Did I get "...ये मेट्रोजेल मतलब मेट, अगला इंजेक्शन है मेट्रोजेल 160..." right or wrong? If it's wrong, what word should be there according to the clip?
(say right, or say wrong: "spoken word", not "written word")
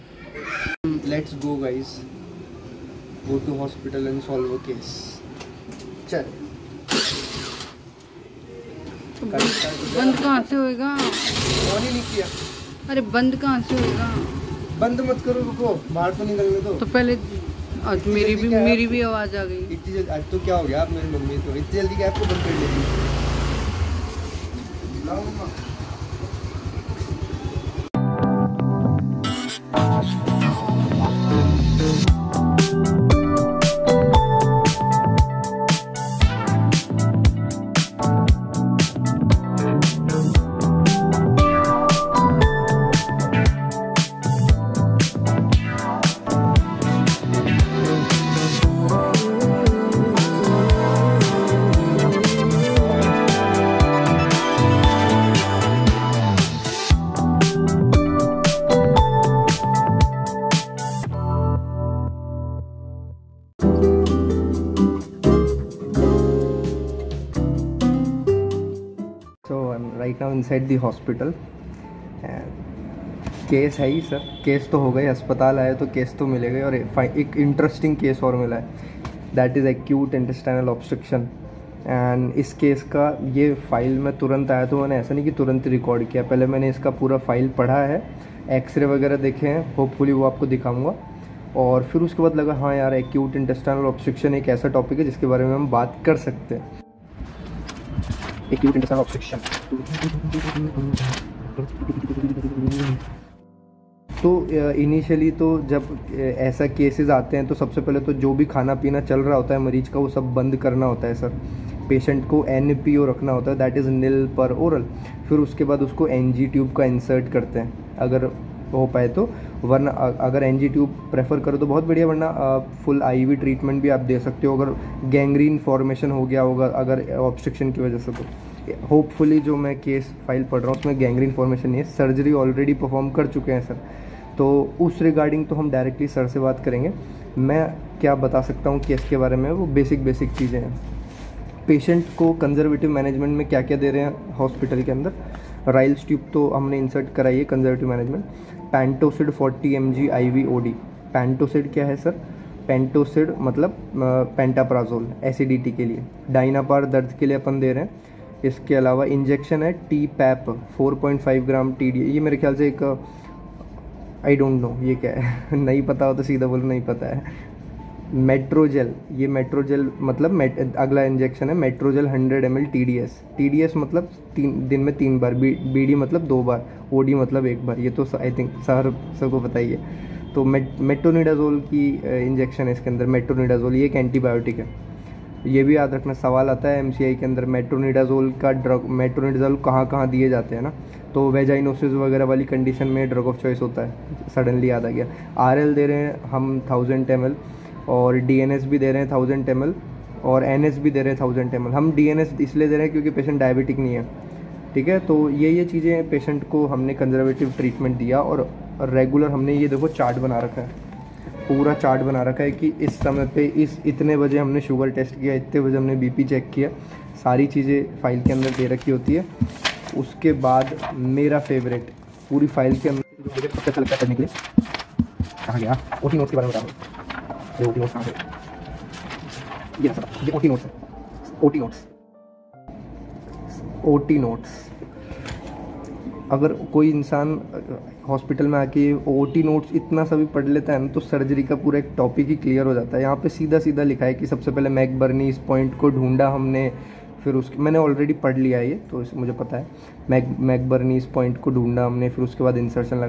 wrong: "100", not "160".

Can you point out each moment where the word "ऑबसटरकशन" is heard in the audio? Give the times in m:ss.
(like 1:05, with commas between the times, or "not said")
1:20, 1:33, 2:07.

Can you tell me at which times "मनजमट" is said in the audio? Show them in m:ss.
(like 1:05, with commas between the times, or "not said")
2:22, 2:27.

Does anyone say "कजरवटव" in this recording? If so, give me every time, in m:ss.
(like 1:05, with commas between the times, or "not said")
2:22, 2:27, 3:26.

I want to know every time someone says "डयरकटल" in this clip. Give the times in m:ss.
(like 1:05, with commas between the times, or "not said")
2:15.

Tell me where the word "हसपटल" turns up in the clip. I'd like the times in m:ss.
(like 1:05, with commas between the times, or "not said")
0:03, 2:24, 3:58.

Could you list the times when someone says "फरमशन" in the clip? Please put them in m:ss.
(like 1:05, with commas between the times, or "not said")
2:05, 2:11.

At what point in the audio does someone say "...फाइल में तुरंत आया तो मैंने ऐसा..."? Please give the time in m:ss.
1:23.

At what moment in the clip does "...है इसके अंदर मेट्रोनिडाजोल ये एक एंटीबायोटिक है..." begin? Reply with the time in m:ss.
3:02.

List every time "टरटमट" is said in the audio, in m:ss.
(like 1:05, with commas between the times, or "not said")
2:03, 3:27.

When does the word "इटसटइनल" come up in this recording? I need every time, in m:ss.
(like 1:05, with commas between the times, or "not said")
1:20, 1:33.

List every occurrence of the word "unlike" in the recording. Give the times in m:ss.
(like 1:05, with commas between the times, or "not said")
not said.